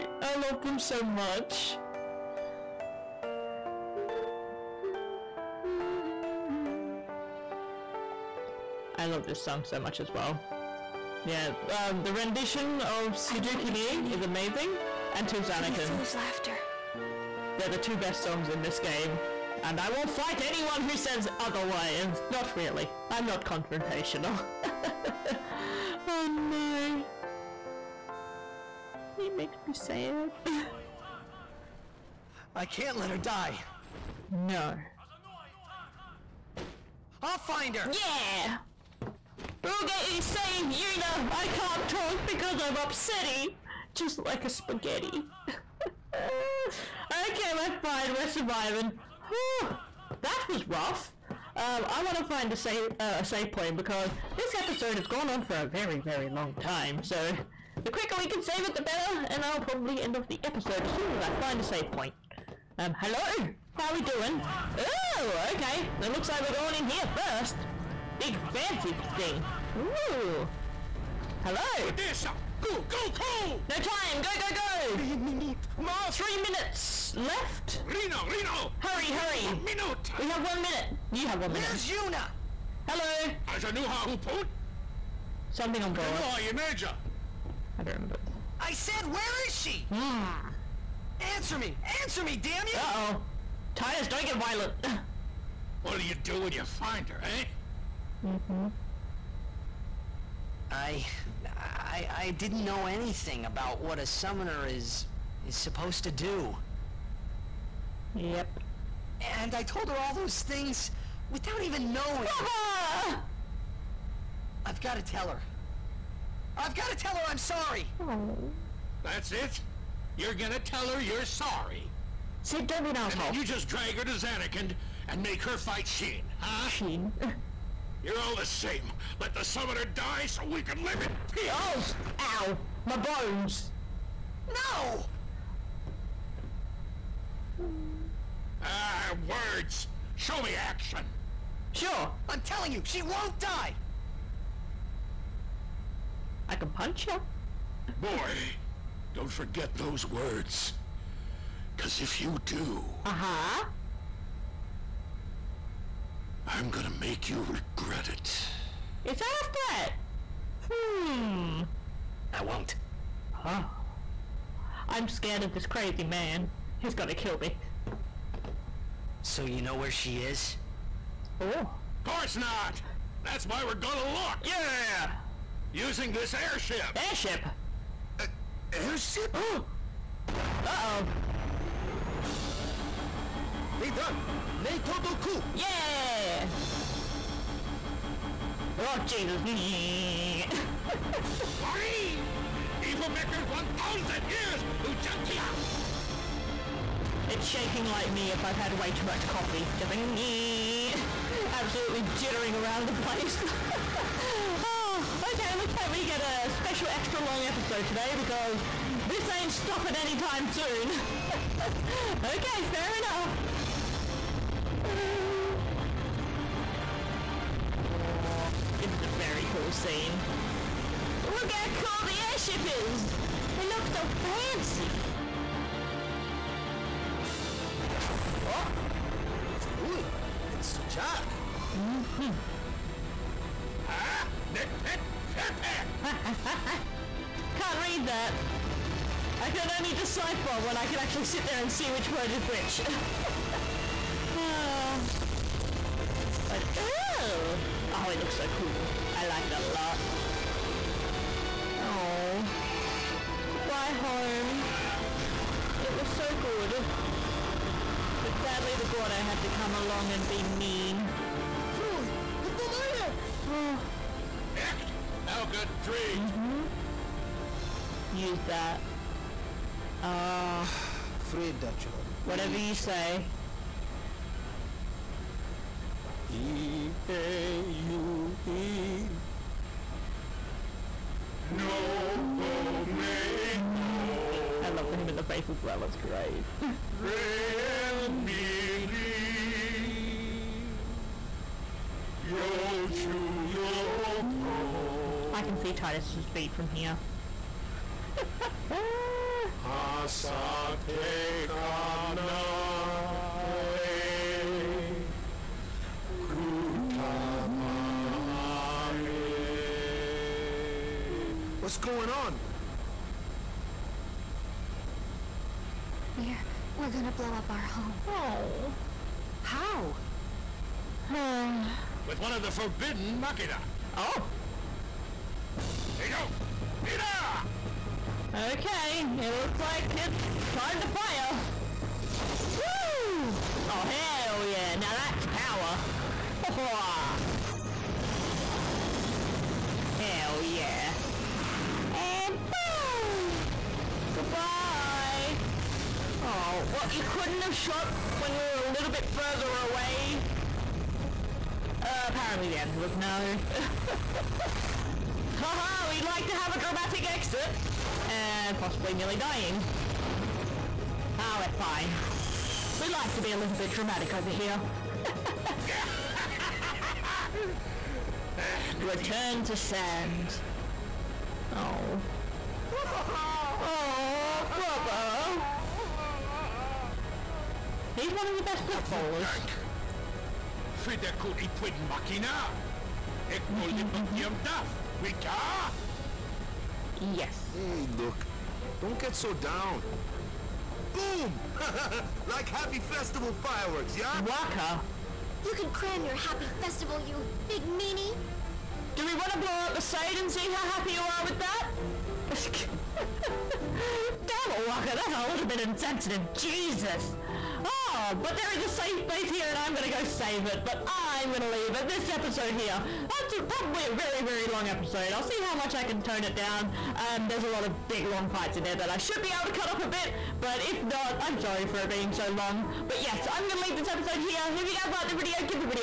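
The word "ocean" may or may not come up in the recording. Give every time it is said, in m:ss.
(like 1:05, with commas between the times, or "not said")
not said.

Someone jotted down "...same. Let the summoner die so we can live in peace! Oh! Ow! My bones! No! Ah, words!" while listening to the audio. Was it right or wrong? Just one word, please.
right.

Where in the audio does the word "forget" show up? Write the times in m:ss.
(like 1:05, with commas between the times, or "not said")
2:29.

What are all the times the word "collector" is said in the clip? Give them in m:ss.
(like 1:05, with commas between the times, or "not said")
not said.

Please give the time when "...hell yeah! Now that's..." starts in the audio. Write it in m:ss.
5:33.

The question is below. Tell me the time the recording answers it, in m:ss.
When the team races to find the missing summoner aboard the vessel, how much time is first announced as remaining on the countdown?
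1:16.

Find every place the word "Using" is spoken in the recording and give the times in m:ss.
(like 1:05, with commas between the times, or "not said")
2:55.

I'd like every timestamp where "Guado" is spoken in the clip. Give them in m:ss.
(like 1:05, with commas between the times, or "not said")
4:18.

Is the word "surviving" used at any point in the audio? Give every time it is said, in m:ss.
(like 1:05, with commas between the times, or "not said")
0:48.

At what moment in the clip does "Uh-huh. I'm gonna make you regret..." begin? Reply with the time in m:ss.
2:33.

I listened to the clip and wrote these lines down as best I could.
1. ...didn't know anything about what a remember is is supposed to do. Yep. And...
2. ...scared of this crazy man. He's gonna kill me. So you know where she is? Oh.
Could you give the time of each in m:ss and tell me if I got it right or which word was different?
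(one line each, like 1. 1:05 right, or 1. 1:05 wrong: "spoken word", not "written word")
1. 1:42 wrong: "summoner", not "remember"
2. 2:45 right.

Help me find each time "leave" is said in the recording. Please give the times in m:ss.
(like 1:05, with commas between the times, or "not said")
6:51, 7:03.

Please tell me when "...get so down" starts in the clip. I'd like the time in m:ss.
6:28.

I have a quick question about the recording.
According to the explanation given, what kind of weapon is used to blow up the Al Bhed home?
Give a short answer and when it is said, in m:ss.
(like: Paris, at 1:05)
Forbidden machina, at 5:22.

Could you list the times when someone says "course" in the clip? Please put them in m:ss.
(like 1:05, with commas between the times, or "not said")
2:52.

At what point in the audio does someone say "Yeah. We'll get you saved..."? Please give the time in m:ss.
0:37.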